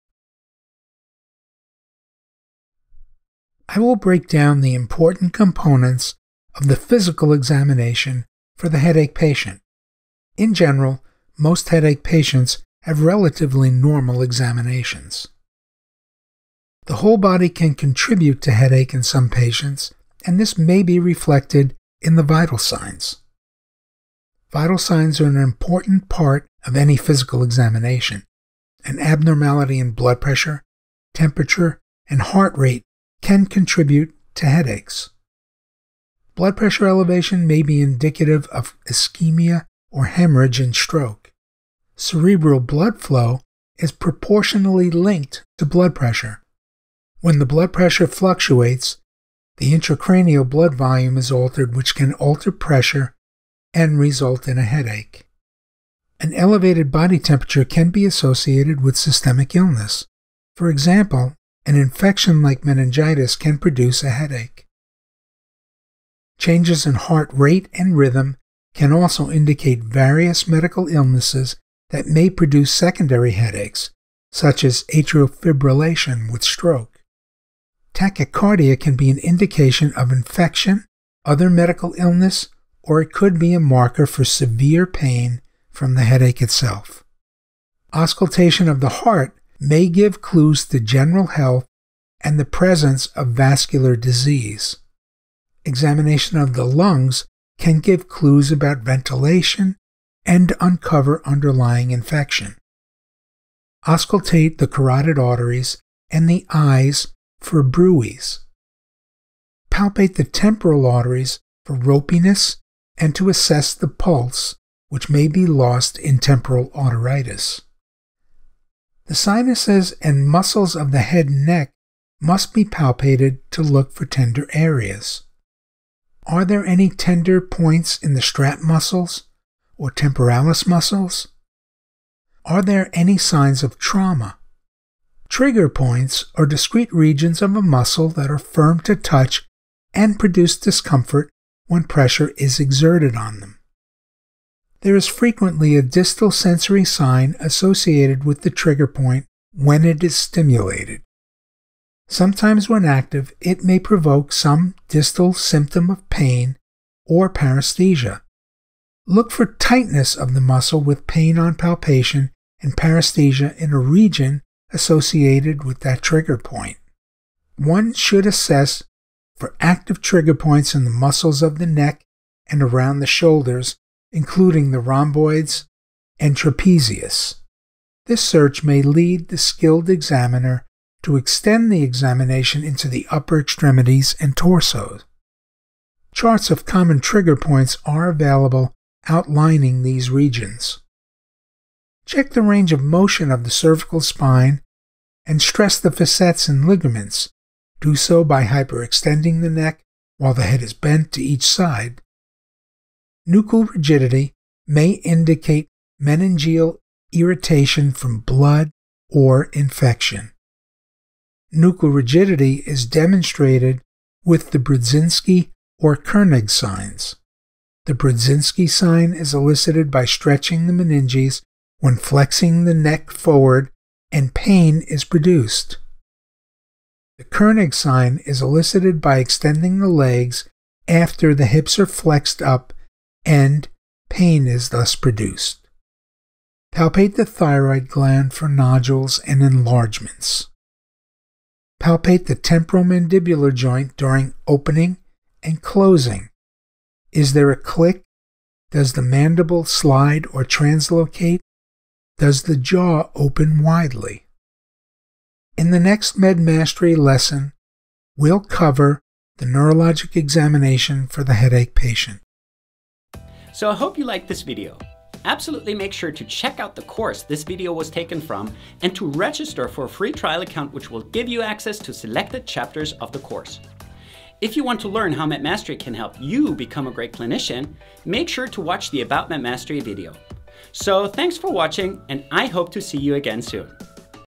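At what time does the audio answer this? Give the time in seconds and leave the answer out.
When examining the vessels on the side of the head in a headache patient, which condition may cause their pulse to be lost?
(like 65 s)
116 s.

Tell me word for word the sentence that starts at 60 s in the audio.
For example, an infection like meningitis can produce a headache.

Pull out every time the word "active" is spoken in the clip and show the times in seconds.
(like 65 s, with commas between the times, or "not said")
152 s, 169 s.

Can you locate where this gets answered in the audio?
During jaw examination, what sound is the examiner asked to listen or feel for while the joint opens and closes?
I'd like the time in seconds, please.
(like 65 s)
247 s.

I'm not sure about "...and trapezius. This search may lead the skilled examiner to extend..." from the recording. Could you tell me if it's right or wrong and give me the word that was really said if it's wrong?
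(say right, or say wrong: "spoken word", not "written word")
right.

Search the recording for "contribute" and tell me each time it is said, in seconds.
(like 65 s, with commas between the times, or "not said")
17 s, 33 s.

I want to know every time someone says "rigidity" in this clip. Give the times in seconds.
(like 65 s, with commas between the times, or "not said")
203 s, 211 s.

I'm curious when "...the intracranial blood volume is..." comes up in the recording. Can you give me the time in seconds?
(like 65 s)
49 s.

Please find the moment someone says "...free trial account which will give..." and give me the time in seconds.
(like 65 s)
269 s.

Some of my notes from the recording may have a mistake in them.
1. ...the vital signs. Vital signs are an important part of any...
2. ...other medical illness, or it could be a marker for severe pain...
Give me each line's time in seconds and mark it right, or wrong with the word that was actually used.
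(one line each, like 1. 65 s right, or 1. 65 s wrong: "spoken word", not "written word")
1. 22 s right
2. 81 s right.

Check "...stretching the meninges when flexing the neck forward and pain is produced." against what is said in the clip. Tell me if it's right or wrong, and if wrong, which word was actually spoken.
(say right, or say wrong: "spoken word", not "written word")
right.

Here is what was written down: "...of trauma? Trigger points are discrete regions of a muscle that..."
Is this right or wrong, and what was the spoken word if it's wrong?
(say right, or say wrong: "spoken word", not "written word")
right.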